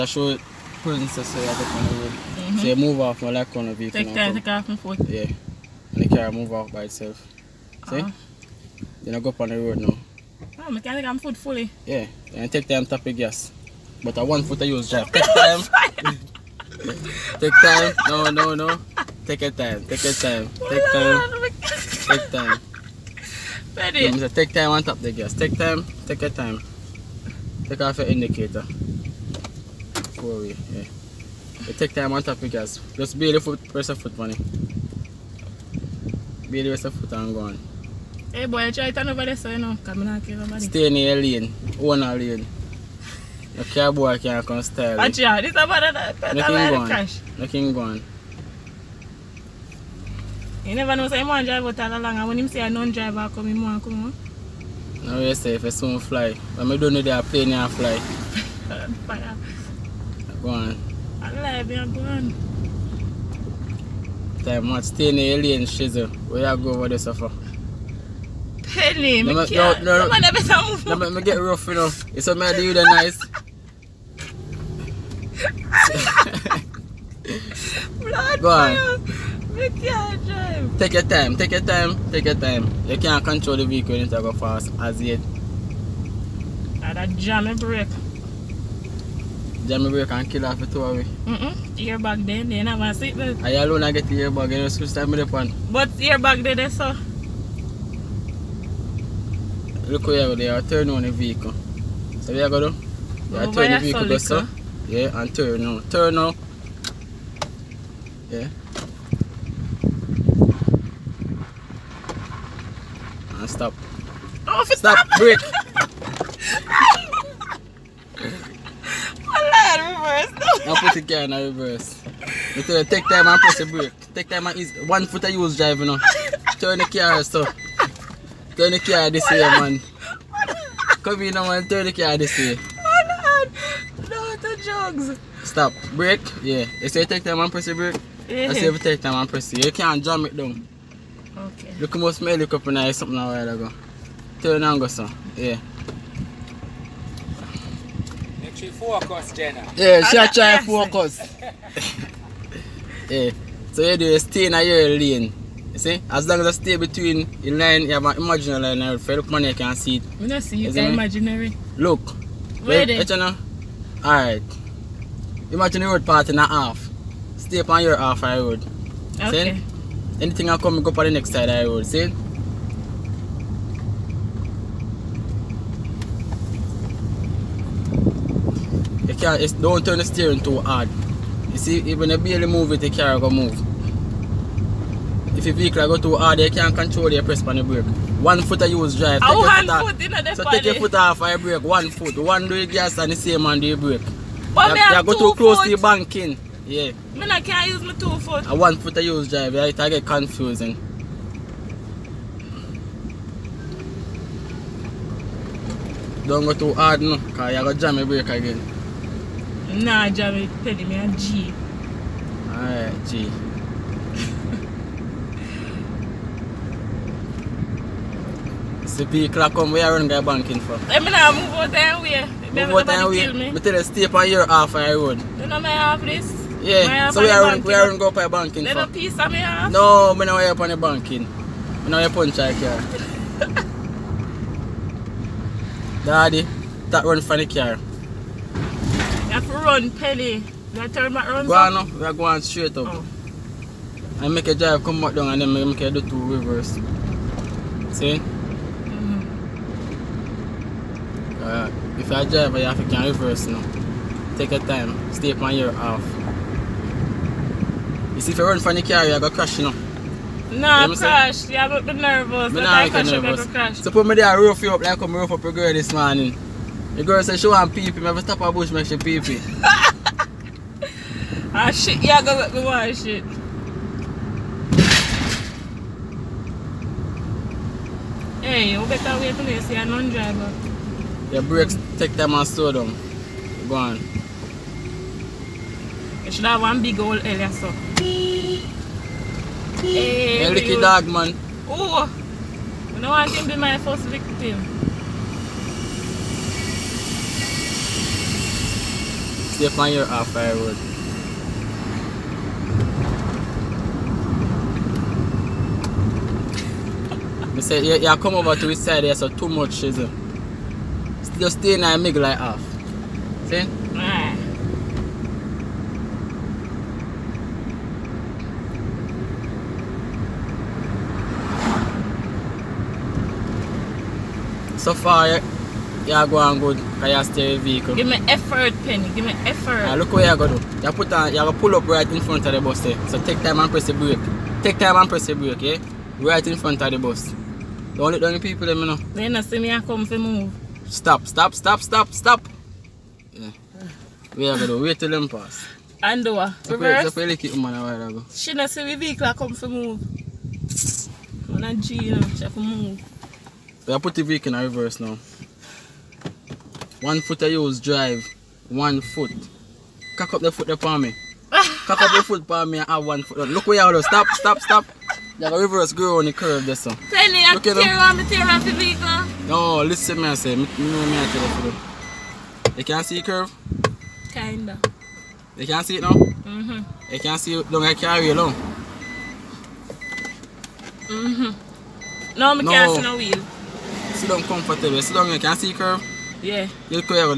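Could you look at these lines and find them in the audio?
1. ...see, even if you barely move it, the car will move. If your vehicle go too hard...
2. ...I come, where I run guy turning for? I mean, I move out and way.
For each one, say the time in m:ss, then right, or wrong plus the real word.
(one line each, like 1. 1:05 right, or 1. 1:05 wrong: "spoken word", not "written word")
1. 3:01 right
2. 3:39 wrong: "banking", not "turning".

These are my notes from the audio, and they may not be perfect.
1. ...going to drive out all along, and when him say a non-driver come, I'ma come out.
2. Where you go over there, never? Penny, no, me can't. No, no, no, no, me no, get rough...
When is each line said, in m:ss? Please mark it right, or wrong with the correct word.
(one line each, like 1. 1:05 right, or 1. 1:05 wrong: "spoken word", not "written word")
1. 0:51 right
2. 1:06 wrong: "suffer", not "never".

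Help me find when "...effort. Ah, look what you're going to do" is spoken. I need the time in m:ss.
5:29.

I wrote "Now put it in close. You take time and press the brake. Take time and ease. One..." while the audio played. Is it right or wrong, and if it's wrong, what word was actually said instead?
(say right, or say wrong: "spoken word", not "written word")
wrong: "reverse", not "close".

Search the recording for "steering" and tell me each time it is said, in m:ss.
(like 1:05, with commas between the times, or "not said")
3:00, 5:27.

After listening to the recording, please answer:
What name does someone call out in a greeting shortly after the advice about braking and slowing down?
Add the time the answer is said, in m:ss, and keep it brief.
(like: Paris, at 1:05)
Ricky dog, at 4:50.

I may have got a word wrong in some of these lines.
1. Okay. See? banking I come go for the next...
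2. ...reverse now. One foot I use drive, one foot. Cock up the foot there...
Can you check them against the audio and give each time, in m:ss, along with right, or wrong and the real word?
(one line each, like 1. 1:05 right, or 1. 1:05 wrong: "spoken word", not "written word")
1. 2:49 wrong: "anything", not "banking"
2. 5:54 right.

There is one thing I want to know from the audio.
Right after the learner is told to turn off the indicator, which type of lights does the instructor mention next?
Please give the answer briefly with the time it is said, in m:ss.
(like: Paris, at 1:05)
Four way, at 0:30.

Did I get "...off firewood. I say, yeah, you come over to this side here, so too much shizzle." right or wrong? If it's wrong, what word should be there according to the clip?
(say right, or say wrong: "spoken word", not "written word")
right.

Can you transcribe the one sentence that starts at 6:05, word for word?
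You have a reverse girl on the curve there, son.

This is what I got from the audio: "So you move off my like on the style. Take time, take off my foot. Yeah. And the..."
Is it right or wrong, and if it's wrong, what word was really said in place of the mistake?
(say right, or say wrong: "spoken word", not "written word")
wrong: "vehicle", not "style".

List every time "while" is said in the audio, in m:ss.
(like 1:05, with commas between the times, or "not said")
2:23, 5:47.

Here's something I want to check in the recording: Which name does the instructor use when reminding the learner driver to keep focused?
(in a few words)
Jenna.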